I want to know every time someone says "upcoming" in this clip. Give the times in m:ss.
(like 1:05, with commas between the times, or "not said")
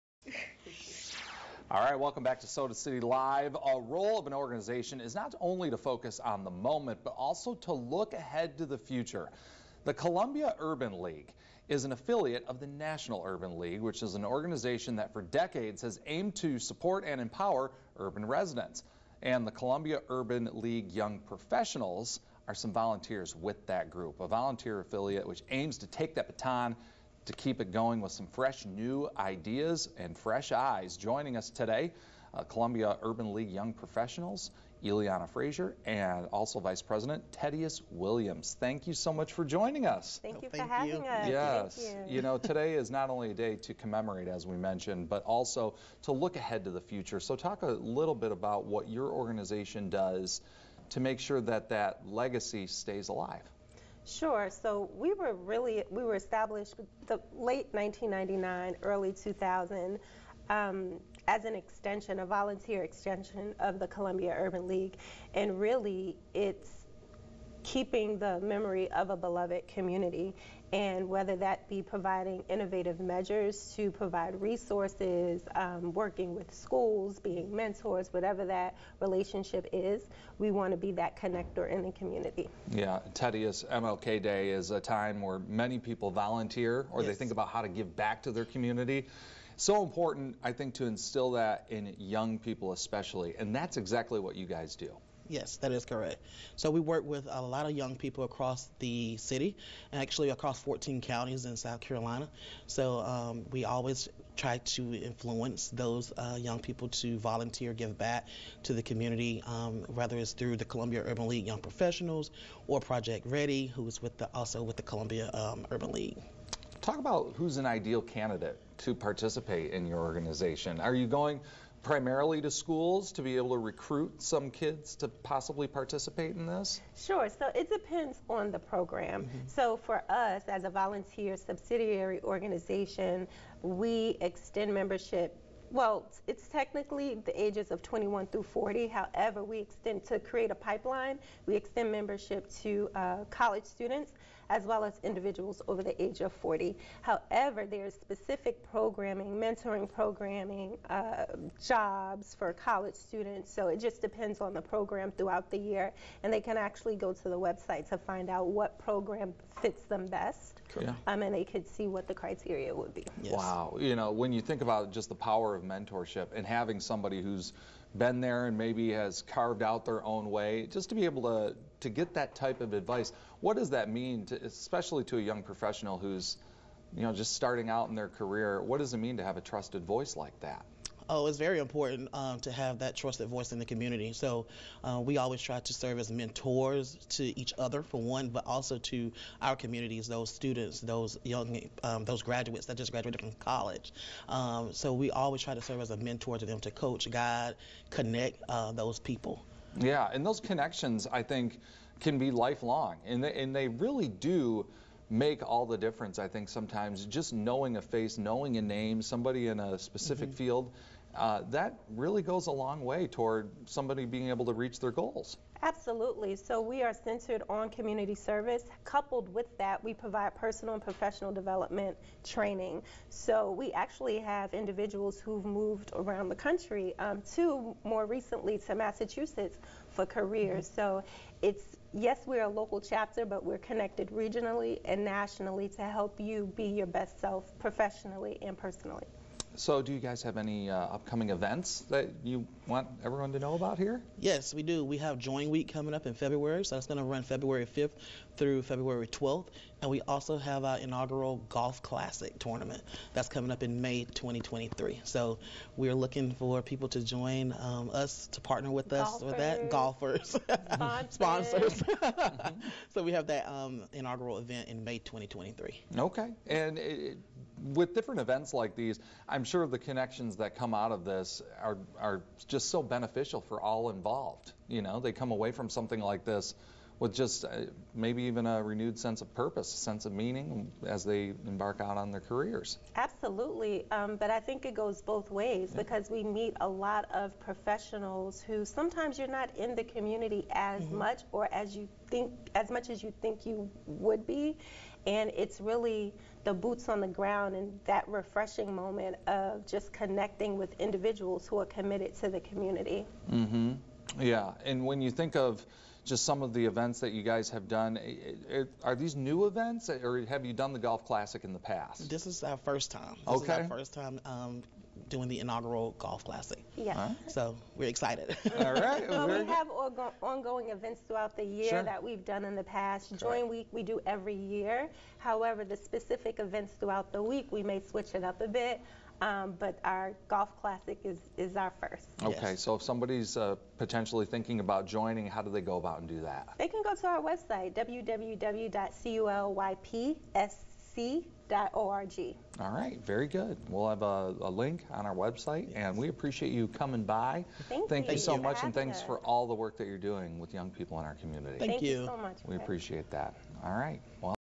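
4:00.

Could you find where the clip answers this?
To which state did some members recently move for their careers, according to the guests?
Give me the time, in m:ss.
3:48.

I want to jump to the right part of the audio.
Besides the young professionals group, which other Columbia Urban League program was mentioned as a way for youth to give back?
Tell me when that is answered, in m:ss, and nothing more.
1:52.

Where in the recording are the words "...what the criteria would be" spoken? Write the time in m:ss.
2:41.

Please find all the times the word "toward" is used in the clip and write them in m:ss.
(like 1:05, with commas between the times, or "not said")
3:33.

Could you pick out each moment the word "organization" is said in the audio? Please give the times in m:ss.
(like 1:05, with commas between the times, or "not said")
0:04, 0:14, 0:49, 1:59, 2:12.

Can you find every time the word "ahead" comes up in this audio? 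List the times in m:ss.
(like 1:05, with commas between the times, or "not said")
0:08, 0:46.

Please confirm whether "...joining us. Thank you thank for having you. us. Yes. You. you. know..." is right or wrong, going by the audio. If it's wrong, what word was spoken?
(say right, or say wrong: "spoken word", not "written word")
right.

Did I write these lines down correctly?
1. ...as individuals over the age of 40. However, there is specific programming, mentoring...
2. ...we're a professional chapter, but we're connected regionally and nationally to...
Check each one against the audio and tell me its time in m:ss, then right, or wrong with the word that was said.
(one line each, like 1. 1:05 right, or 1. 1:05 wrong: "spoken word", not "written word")
1. 2:24 right
2. 3:52 wrong: "local", not "professional".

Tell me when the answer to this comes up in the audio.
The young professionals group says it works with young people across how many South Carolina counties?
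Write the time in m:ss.
1:40.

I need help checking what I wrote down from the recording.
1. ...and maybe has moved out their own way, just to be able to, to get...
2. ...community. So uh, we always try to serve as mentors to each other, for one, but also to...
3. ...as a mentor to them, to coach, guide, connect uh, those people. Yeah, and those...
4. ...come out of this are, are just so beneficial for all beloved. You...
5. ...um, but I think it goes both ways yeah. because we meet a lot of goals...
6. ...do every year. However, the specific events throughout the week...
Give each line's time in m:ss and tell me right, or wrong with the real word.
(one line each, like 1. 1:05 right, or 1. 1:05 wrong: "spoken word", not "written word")
1. 2:48 wrong: "carved", not "moved"
2. 3:03 right
3. 3:15 right
4. 4:30 wrong: "involved", not "beloved"
5. 4:43 wrong: "professionals", not "goals"
6. 5:23 right.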